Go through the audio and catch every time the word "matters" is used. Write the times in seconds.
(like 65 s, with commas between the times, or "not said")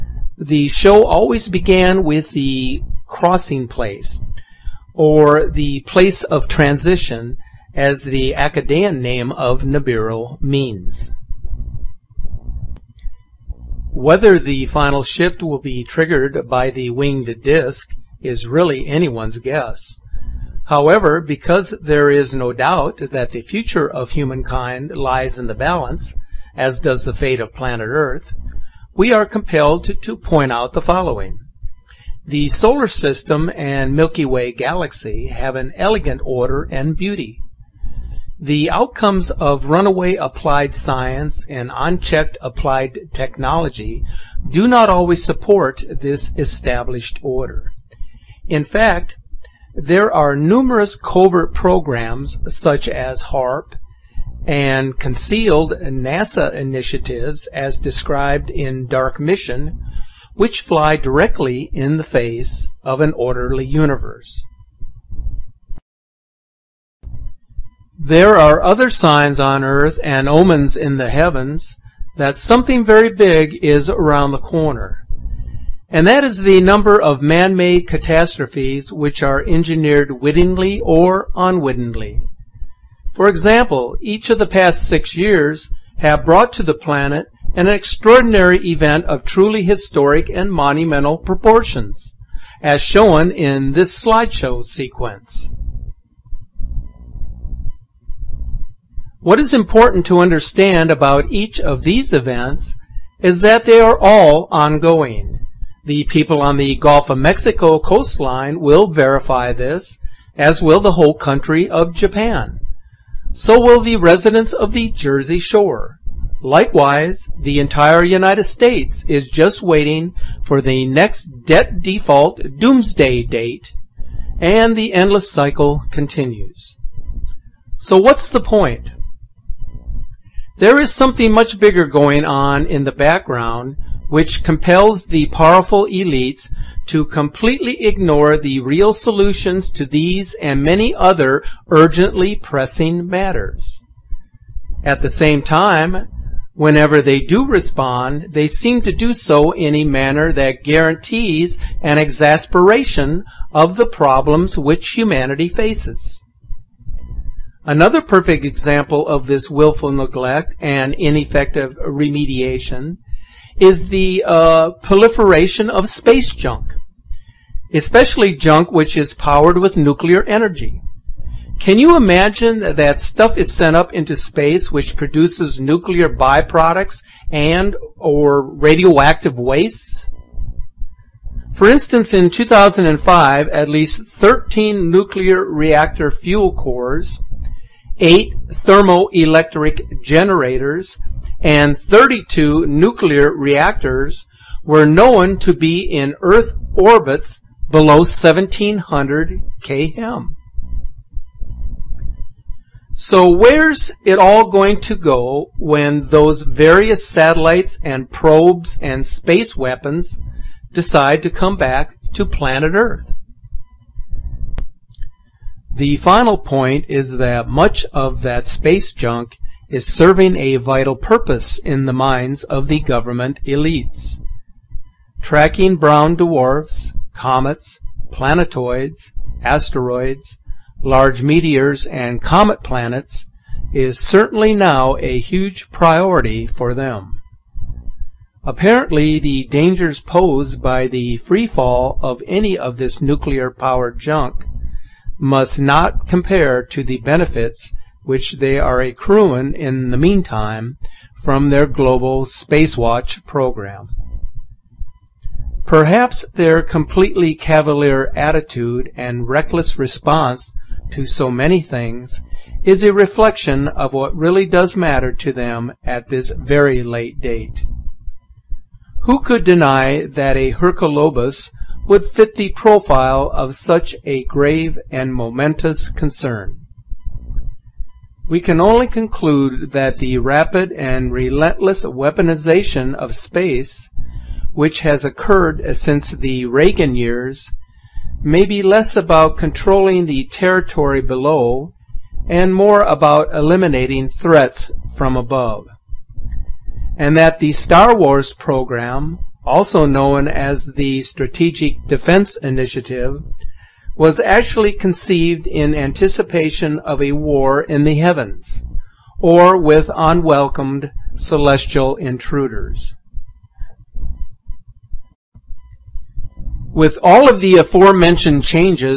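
143 s, 264 s.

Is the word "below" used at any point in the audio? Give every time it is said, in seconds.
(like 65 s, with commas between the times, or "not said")
197 s, 291 s.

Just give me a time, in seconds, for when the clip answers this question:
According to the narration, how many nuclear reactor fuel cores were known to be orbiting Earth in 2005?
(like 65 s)
184 s.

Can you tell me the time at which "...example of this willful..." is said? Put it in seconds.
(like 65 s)
158 s.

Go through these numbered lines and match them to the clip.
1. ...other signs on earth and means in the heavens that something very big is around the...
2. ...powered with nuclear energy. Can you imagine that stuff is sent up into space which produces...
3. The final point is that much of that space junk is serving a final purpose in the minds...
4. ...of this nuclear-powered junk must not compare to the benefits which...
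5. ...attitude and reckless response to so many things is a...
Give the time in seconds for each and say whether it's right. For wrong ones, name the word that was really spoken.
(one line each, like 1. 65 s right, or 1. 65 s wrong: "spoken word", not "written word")
1. 68 s wrong: "omens", not "means"
2. 169 s right
3. 215 s wrong: "vital", not "final"
4. 242 s right
5. 258 s right.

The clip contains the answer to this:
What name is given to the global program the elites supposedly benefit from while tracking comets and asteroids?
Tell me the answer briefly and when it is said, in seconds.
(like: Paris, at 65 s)
Spacewatch, at 252 s.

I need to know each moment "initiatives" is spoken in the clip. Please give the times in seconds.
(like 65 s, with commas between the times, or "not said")
56 s, 302 s.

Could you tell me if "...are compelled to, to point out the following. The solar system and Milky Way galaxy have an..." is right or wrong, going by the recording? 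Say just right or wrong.
right.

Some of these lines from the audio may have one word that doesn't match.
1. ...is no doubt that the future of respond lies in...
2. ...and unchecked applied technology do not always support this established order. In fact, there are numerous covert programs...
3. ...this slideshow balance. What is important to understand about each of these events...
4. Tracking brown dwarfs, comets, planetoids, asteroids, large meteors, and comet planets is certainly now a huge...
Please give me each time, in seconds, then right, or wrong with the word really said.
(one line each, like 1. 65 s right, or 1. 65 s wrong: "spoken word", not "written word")
1. 22 s wrong: "humankind", not "respond"
2. 41 s right
3. 93 s wrong: "sequence", not "balance"
4. 225 s right.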